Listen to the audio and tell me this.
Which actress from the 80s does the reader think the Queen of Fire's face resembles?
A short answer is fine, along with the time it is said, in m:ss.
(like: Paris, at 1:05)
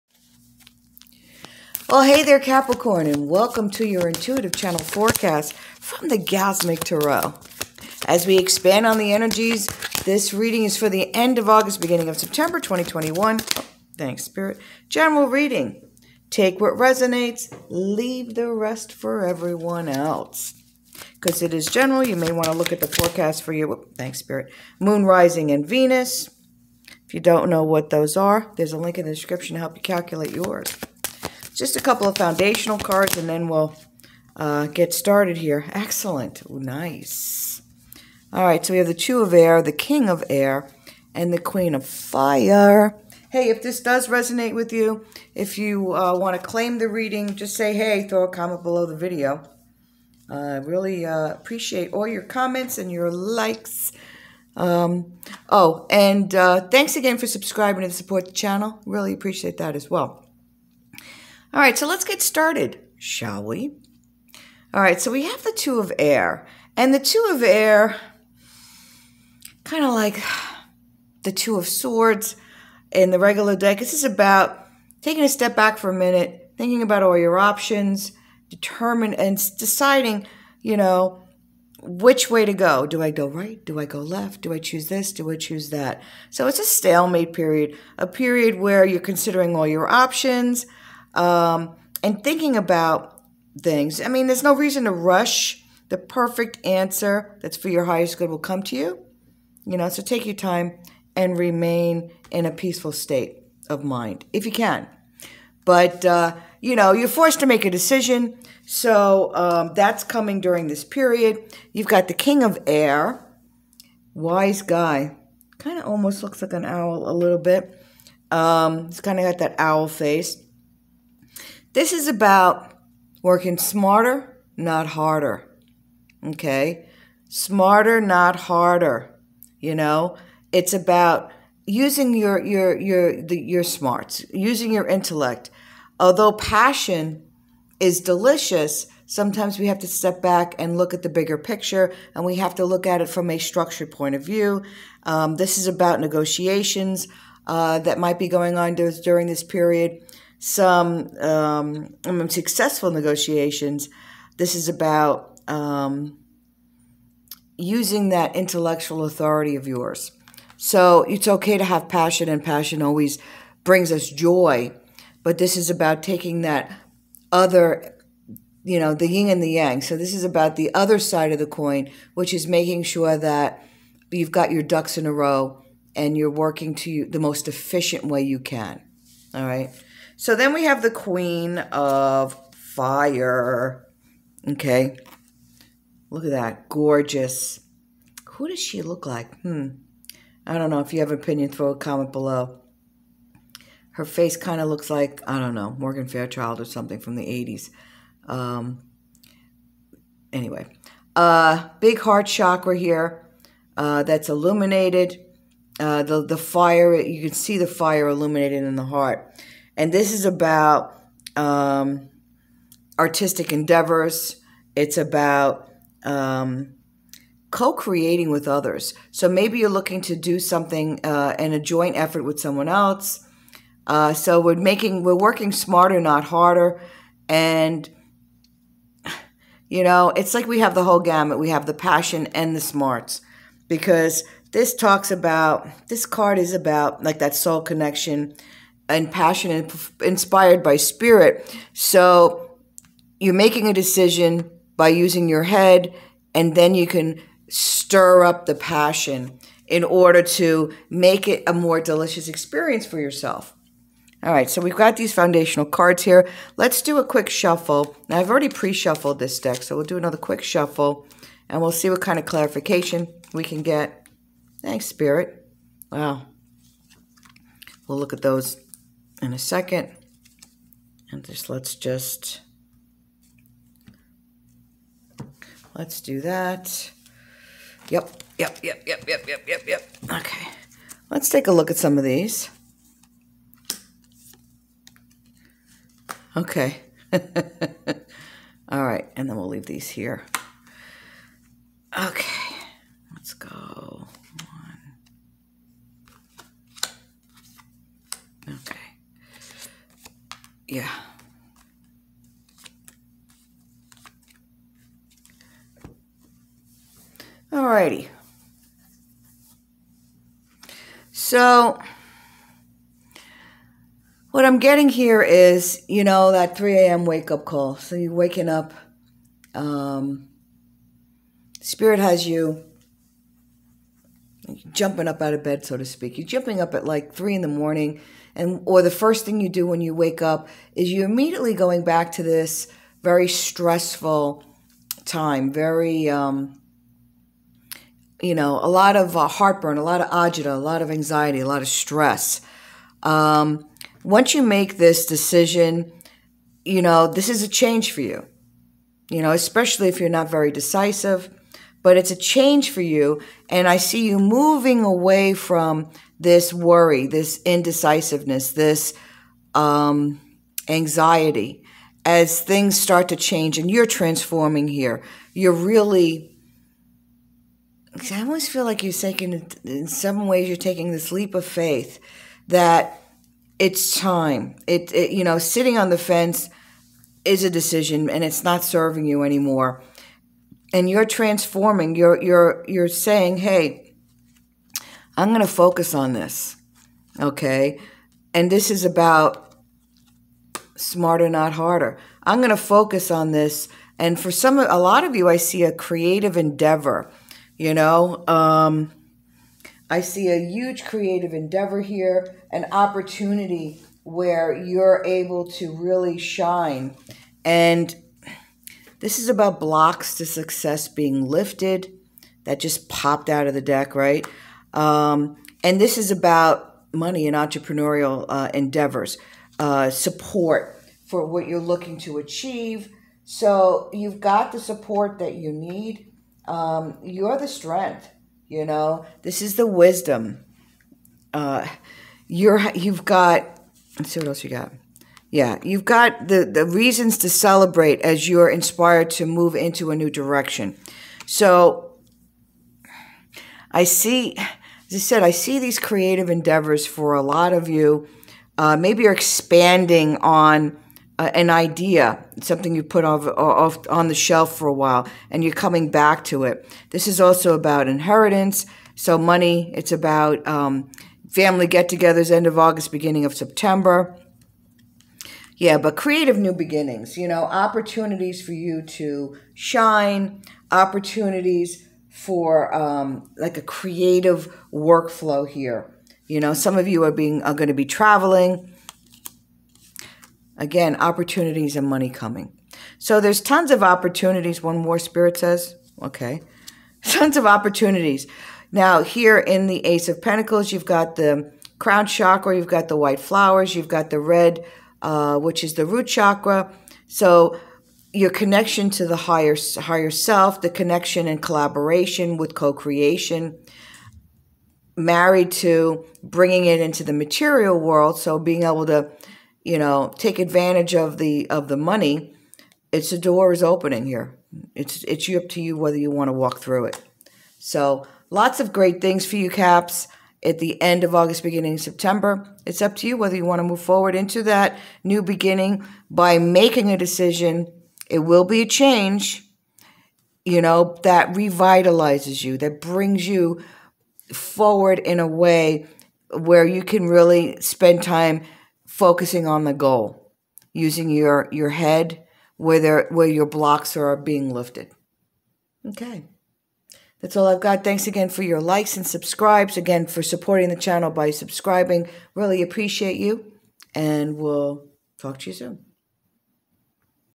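Morgan Fairchild, at 3:15.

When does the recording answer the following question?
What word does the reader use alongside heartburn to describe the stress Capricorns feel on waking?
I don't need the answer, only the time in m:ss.
5:40.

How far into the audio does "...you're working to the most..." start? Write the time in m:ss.
2:56.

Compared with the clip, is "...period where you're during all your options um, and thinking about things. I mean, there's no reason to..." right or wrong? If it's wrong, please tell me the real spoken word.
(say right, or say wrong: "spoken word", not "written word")
wrong: "considering", not "during".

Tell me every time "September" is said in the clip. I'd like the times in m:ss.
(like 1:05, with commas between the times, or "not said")
0:12, 7:43, 8:41.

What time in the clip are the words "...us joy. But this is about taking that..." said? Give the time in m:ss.
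2:43.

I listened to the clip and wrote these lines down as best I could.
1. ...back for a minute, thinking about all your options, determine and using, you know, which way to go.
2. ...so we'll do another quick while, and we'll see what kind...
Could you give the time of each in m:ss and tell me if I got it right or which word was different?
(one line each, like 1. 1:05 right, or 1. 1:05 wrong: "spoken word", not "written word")
1. 1:15 wrong: "deciding", not "using"
2. 4:19 wrong: "shuffle", not "while".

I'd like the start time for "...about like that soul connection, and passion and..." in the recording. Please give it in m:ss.
3:56.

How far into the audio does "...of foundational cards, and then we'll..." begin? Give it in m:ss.
0:32.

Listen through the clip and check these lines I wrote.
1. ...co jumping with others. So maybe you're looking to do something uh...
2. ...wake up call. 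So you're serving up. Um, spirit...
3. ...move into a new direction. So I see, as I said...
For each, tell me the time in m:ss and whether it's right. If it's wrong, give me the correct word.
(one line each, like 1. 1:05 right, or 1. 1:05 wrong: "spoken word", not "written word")
1. 3:37 wrong: "creating", not "jumping"
2. 5:17 wrong: "waking", not "serving"
3. 7:19 right.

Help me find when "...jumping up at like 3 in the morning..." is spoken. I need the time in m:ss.
5:26.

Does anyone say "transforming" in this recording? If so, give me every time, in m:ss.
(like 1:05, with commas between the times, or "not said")
6:03, 6:21.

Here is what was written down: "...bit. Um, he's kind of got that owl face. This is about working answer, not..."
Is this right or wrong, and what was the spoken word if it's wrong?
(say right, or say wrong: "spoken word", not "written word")
wrong: "smarter", not "answer".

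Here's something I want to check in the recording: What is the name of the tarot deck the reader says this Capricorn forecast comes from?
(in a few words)
Gasmic Tarot.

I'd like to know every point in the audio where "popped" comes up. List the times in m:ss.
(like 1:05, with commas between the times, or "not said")
6:52.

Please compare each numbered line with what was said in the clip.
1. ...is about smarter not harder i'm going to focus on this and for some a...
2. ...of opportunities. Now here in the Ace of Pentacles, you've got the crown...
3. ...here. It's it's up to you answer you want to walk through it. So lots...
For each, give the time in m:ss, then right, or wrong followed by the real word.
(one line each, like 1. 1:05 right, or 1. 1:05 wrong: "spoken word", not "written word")
1. 6:28 right
2. 8:07 right
3. 8:34 wrong: "whether", not "answer".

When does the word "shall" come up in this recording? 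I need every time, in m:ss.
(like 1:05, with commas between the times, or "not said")
1:02.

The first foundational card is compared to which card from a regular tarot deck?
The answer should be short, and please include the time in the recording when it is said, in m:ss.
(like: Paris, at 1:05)
Two of Swords, at 1:11.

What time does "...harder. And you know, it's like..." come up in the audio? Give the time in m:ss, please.
3:46.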